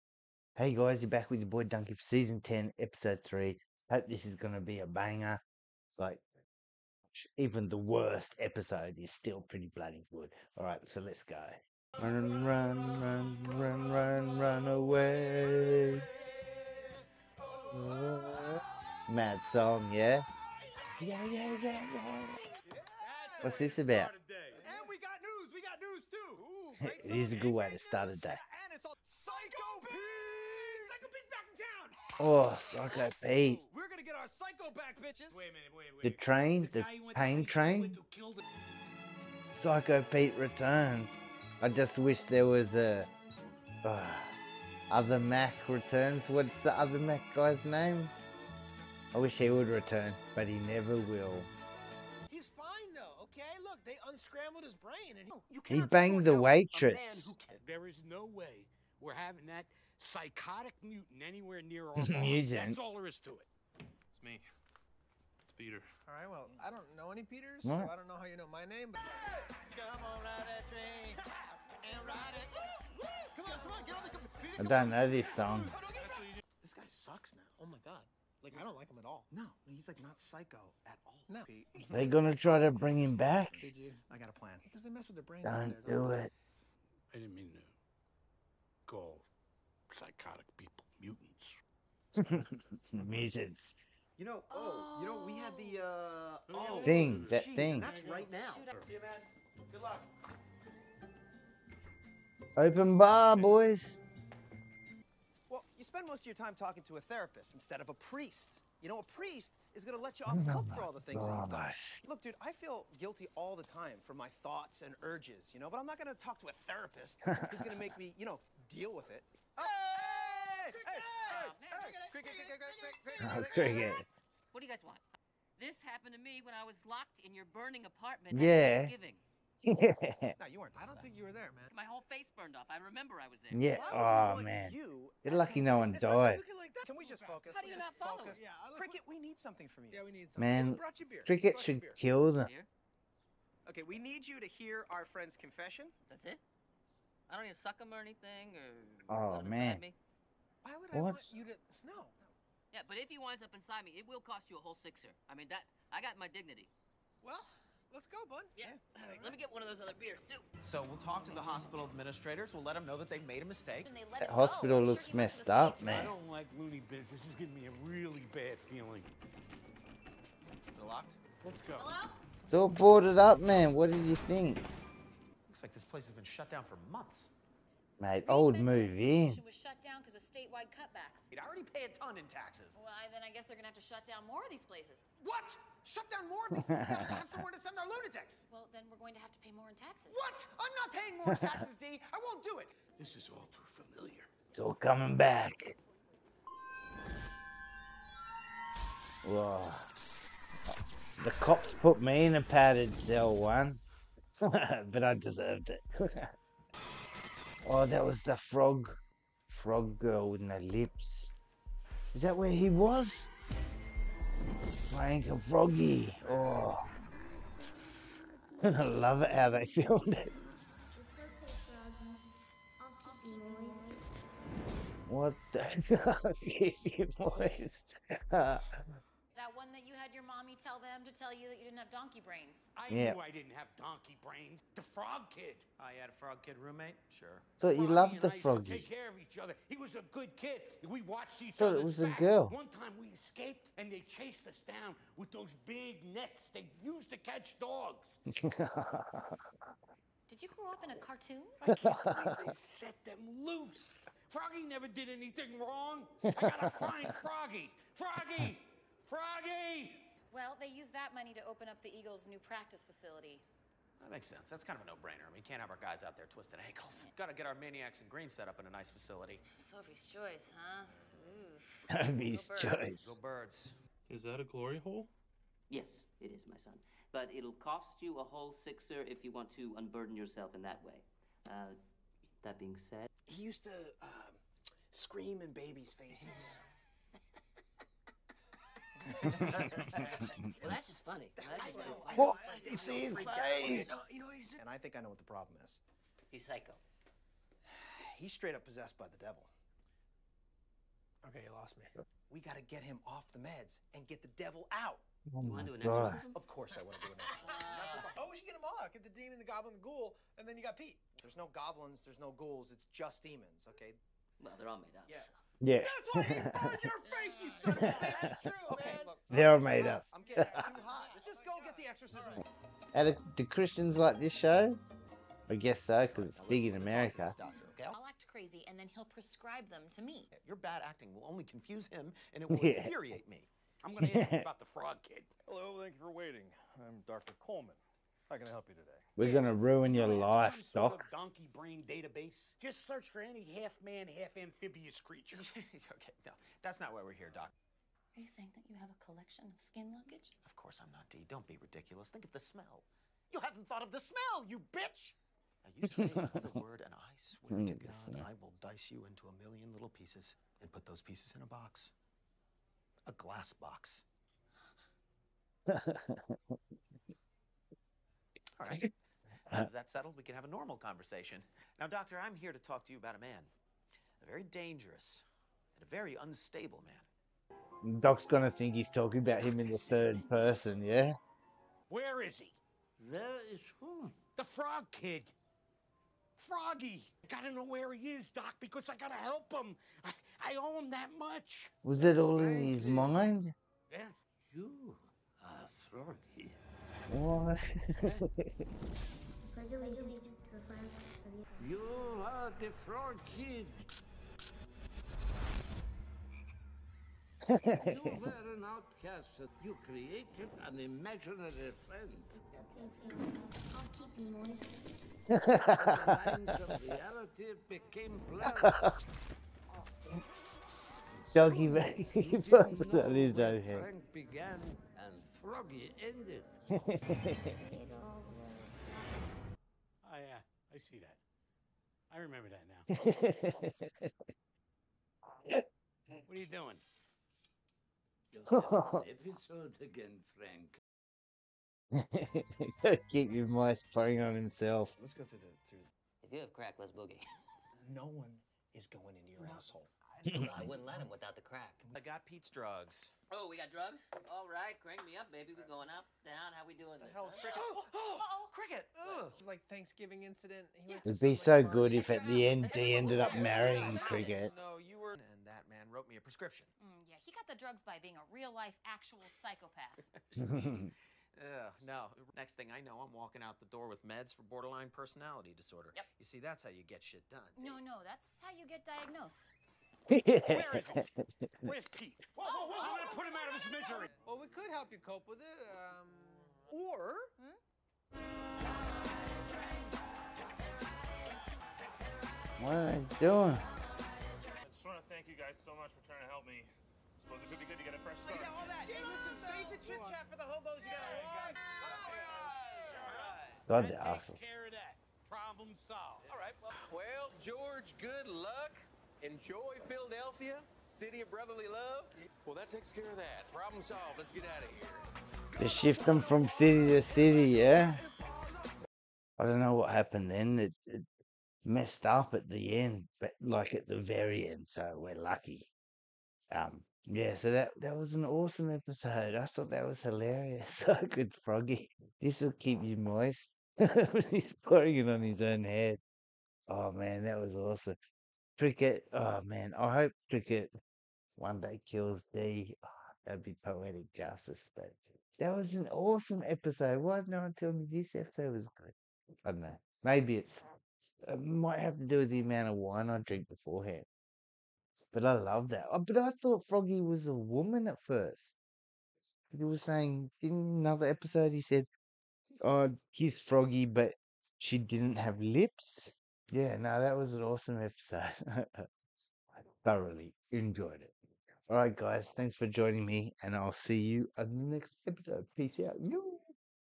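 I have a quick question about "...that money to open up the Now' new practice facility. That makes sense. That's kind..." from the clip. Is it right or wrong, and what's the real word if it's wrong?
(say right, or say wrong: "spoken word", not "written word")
wrong: "Eagles", not "Now".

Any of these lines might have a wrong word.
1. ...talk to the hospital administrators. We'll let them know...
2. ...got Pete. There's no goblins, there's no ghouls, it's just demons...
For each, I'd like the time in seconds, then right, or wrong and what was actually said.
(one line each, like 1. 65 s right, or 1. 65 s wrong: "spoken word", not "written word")
1. 161 s right
2. 310 s right.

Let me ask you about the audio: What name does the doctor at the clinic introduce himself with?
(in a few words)
Dr. Coleman.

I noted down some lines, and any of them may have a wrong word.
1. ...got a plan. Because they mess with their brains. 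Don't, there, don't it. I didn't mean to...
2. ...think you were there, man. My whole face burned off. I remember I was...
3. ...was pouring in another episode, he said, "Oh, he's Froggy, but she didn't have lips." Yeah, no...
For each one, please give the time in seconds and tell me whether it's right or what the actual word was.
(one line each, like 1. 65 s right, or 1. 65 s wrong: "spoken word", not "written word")
1. 84 s right
2. 131 s right
3. 559 s wrong: "saying", not "pouring".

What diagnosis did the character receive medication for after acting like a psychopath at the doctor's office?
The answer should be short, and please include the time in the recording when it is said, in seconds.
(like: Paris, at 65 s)
Borderline personality disorder, at 474 s.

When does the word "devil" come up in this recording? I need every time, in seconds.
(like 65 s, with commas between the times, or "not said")
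299 s, 304 s.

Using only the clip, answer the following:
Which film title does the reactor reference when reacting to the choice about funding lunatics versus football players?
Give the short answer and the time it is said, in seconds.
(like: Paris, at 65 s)
Sophie's Choice, at 269 s.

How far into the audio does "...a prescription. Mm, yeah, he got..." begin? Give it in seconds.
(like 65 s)
466 s.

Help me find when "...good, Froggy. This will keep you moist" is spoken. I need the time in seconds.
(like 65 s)
531 s.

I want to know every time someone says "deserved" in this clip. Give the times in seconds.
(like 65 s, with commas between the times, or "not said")
205 s.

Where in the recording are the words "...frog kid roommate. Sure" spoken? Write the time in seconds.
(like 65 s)
236 s.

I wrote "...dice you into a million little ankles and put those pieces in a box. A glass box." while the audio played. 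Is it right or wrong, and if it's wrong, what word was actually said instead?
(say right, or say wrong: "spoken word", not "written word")
wrong: "pieces", not "ankles".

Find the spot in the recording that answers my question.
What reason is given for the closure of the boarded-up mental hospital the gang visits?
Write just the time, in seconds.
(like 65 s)
180 s.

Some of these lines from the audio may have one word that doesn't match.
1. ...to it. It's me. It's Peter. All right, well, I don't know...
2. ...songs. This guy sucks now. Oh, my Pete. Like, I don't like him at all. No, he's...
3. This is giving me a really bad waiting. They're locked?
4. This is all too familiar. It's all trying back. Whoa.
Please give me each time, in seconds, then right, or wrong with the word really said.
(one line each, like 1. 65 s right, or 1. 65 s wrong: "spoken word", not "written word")
1. 63 s right
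2. 75 s wrong: "God", not "Pete"
3. 167 s wrong: "feeling", not "waiting"
4. 192 s wrong: "coming", not "trying".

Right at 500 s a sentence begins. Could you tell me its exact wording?
You got a God, they're awesome.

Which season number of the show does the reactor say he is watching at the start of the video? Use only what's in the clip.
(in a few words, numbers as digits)
10.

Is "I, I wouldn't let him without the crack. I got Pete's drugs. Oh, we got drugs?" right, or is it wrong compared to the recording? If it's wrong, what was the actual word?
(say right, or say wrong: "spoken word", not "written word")
right.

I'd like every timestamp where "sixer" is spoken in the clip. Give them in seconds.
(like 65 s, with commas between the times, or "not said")
154 s, 278 s.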